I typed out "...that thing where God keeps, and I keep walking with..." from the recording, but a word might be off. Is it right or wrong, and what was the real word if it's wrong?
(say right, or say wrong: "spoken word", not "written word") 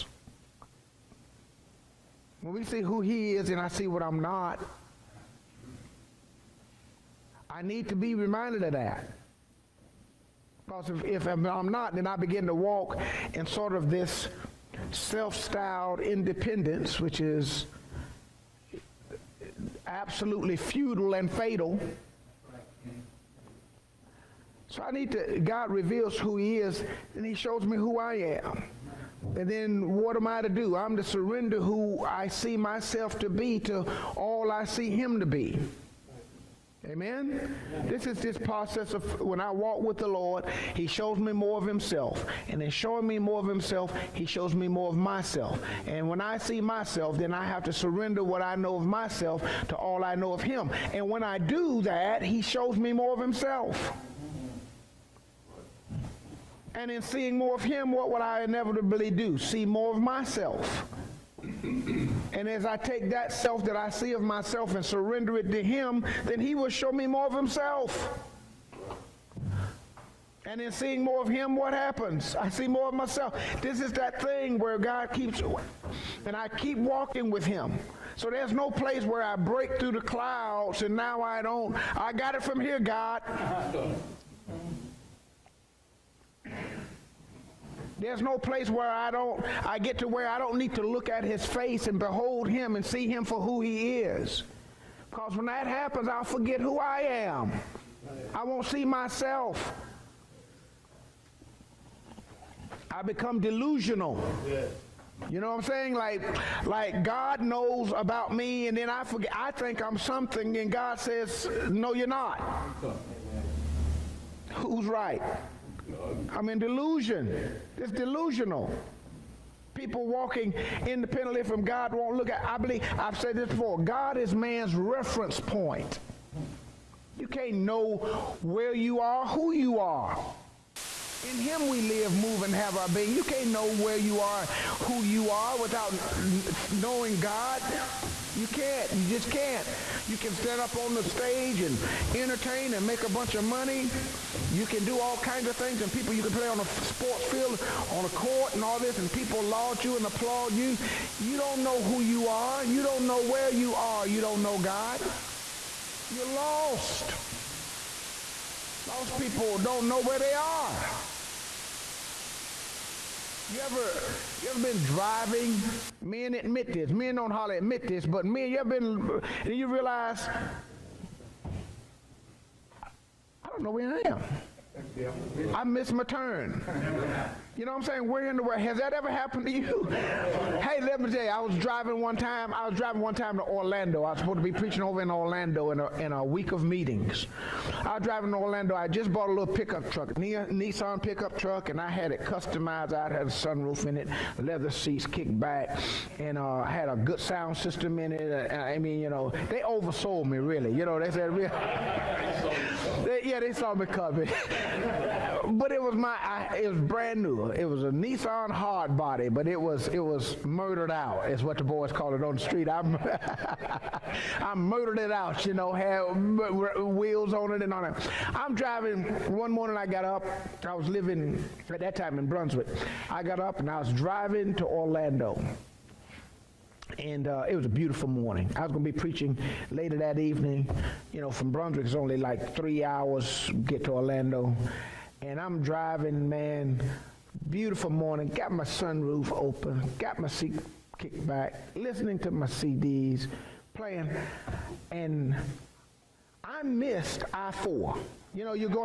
right.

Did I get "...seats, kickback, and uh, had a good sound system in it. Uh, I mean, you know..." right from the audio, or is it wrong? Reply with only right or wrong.
right.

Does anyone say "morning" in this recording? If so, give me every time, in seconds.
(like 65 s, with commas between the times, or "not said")
219 s, 228 s, 237 s.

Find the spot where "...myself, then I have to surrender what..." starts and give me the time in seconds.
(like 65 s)
46 s.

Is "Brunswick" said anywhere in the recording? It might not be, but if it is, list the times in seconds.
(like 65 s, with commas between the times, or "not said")
222 s, 231 s.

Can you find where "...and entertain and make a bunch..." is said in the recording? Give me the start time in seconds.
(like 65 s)
141 s.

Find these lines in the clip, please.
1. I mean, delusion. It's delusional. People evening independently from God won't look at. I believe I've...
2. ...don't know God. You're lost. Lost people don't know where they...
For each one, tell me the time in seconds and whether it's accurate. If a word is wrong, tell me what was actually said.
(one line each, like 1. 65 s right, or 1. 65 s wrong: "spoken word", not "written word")
1. 116 s wrong: "walking", not "evening"
2. 154 s right.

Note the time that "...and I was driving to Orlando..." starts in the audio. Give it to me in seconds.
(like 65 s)
223 s.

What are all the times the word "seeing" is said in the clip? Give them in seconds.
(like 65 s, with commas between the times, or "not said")
57 s, 70 s.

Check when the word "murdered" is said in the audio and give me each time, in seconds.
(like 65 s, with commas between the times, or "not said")
210 s, 214 s.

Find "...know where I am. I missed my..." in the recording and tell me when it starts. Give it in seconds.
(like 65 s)
173 s.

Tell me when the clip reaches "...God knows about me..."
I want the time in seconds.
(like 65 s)
107 s.